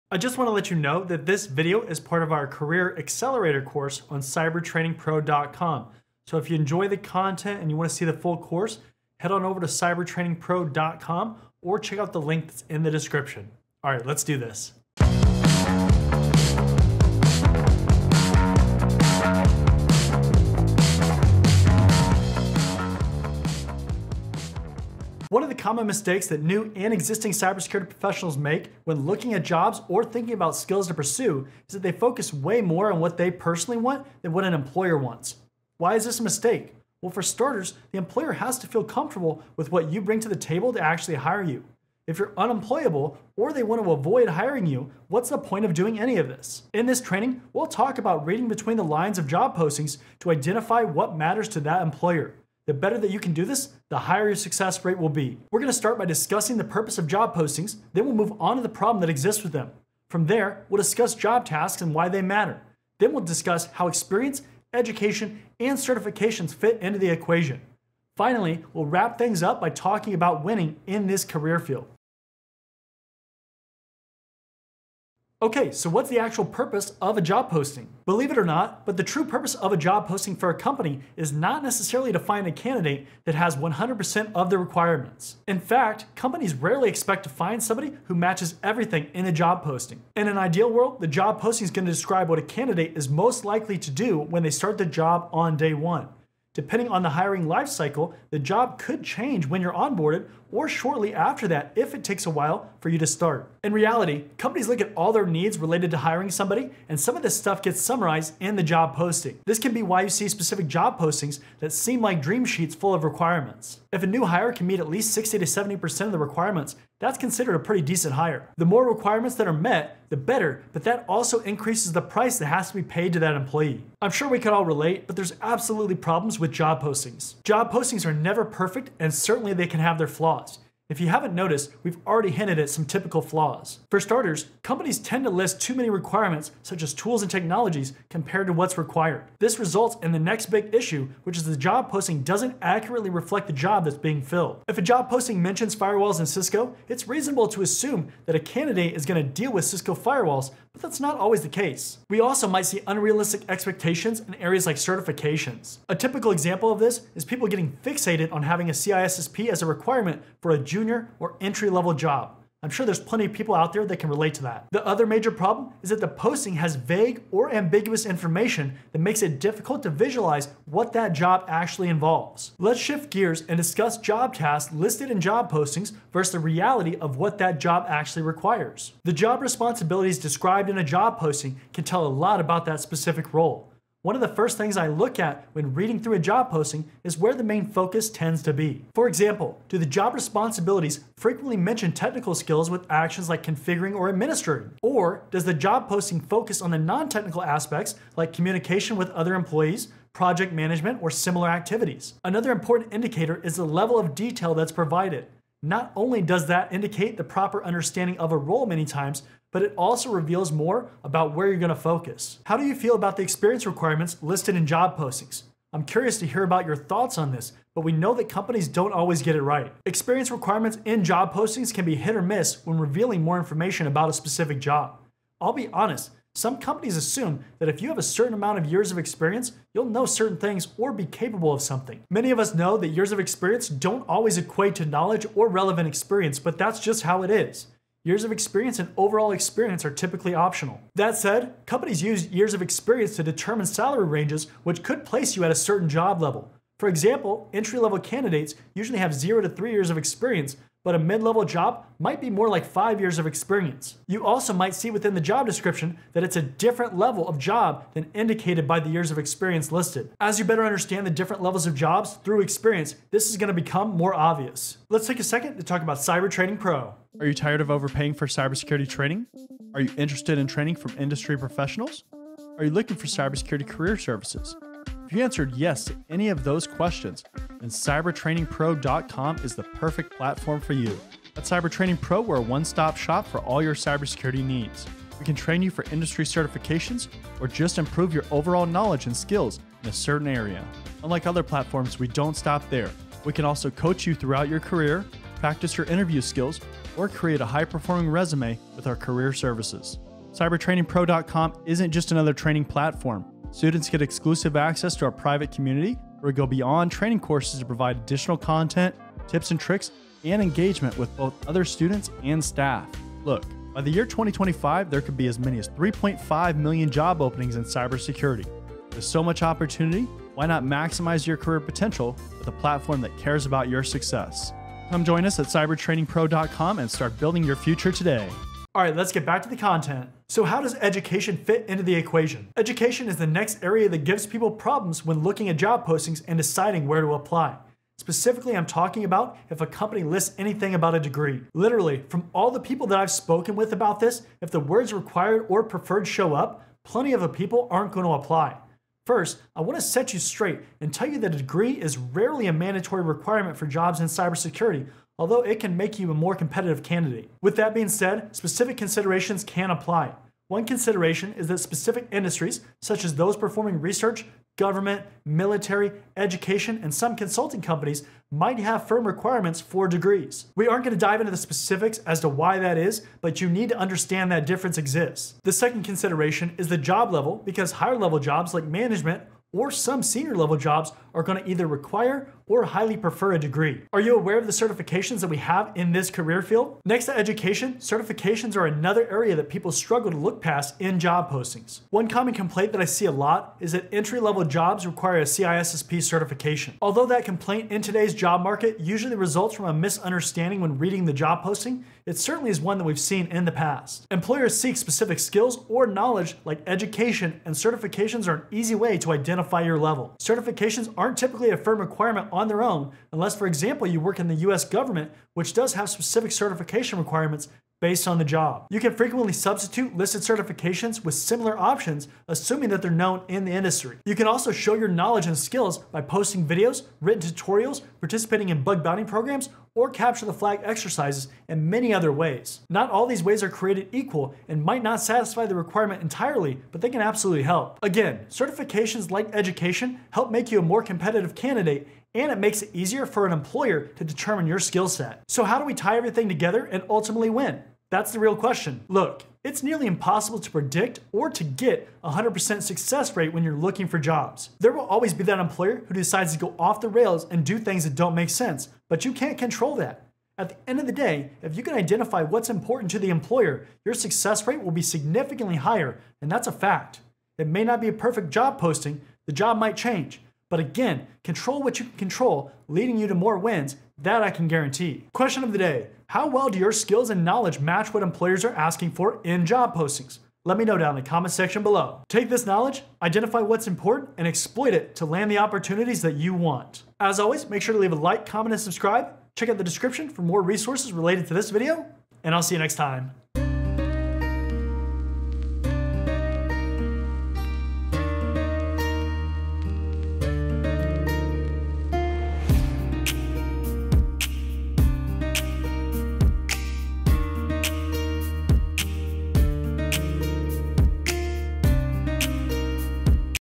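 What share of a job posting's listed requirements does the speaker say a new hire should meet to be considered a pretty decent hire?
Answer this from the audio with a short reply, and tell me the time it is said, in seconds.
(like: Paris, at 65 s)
60 to 70%, at 115 s.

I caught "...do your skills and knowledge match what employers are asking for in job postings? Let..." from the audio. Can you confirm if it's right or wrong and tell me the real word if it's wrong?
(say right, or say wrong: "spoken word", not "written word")
right.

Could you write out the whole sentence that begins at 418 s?
You can frequently substitute listed certifications with similar options, assuming that they're known in the industry.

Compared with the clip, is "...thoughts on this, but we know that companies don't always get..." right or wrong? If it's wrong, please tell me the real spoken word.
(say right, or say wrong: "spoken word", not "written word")
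right.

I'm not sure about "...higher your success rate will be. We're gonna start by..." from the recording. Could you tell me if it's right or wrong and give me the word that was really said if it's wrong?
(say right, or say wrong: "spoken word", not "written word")
right.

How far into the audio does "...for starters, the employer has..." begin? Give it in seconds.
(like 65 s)
37 s.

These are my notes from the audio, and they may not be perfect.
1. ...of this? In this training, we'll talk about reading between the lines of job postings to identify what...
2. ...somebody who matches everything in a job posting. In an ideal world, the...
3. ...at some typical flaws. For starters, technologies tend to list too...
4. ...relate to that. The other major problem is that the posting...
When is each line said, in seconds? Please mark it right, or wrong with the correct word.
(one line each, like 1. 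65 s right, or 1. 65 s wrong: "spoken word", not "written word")
1. 46 s right
2. 87 s right
3. 132 s wrong: "companies", not "technologies"
4. 164 s right.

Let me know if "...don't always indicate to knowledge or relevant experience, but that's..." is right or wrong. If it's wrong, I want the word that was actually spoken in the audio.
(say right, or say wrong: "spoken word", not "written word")
wrong: "equate", not "indicate".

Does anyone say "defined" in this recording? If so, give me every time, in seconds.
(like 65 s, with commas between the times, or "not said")
not said.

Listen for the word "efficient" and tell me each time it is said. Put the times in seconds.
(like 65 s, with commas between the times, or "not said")
not said.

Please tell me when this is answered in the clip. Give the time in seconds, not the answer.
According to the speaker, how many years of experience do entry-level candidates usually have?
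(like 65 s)
249 s.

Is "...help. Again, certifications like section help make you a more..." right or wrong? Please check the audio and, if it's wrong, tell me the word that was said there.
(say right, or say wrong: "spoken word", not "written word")
wrong: "education", not "section".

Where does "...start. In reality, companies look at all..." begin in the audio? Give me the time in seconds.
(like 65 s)
103 s.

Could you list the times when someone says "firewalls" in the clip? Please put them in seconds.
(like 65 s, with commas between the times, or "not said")
145 s, 149 s.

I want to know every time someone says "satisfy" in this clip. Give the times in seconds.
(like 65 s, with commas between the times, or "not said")
435 s.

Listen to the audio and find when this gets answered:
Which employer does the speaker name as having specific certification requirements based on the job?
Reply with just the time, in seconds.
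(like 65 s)
414 s.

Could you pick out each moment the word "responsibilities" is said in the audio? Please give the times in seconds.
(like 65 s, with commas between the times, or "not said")
179 s, 190 s.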